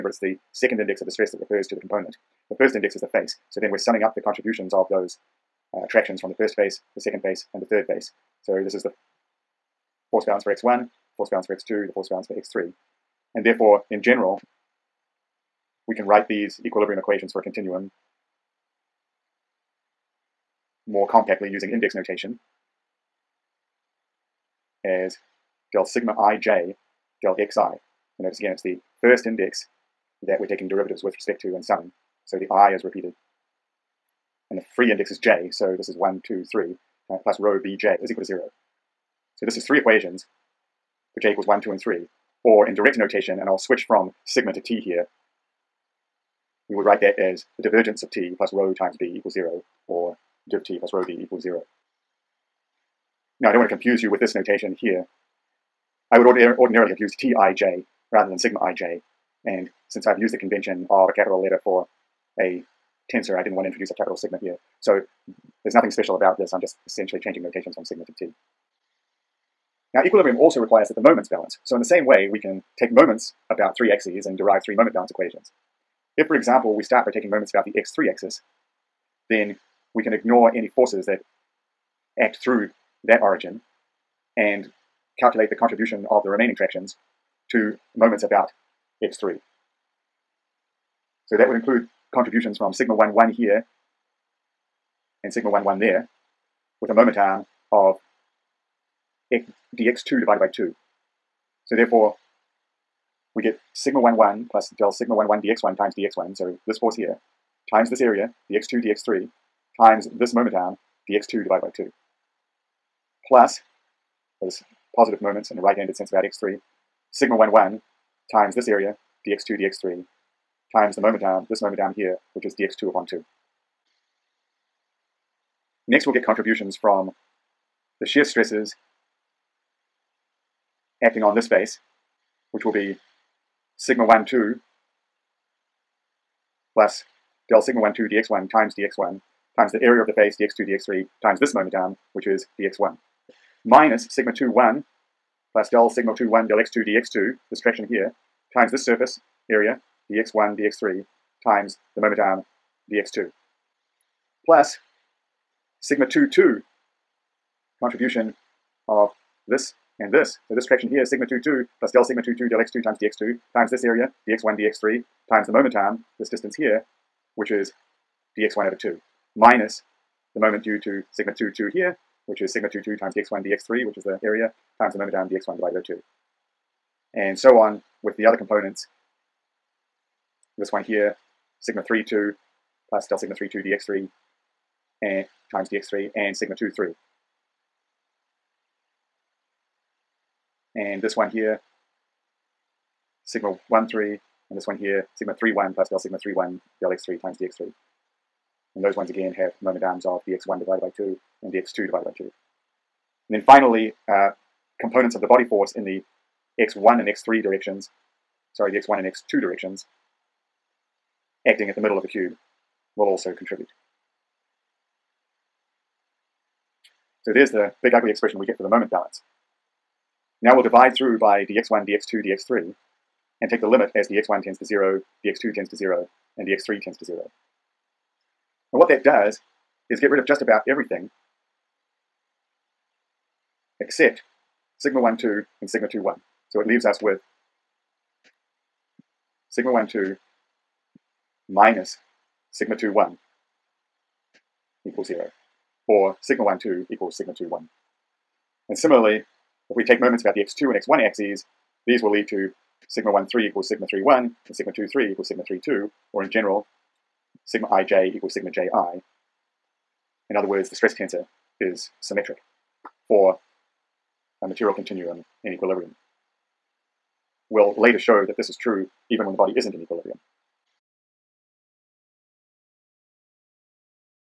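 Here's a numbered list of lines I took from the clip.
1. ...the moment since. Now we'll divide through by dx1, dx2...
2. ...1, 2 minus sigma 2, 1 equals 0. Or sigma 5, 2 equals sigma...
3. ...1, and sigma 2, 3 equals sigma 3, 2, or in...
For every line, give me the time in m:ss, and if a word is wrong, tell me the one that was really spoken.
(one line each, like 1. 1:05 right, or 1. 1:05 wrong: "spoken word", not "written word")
1. 3:38 wrong: "balance", not "since"
2. 3:59 wrong: "1", not "5"
3. 4:14 right.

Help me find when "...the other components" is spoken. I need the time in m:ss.
2:58.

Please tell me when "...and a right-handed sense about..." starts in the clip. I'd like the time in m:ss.
1:55.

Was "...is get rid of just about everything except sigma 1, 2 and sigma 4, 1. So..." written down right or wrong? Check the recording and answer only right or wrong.
wrong.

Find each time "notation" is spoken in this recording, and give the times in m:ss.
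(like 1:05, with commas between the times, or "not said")
0:21, 0:42, 0:54, 1:07.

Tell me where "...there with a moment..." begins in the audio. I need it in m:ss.
1:35.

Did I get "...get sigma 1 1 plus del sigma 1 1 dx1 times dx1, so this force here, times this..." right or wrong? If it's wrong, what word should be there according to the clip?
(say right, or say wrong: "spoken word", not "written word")
right.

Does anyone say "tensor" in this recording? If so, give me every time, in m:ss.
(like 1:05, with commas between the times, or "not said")
1:03, 4:20.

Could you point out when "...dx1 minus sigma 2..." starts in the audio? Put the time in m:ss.
2:22.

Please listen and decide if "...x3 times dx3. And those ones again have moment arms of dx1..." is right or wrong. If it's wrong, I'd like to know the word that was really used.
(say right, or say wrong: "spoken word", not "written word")
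right.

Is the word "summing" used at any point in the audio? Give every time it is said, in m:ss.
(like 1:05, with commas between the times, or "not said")
0:03, 0:31.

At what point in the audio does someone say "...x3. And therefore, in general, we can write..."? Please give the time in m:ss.
0:12.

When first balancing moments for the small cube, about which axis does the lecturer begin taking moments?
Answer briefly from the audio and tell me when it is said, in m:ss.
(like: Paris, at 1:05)
x3 axis, at 1:17.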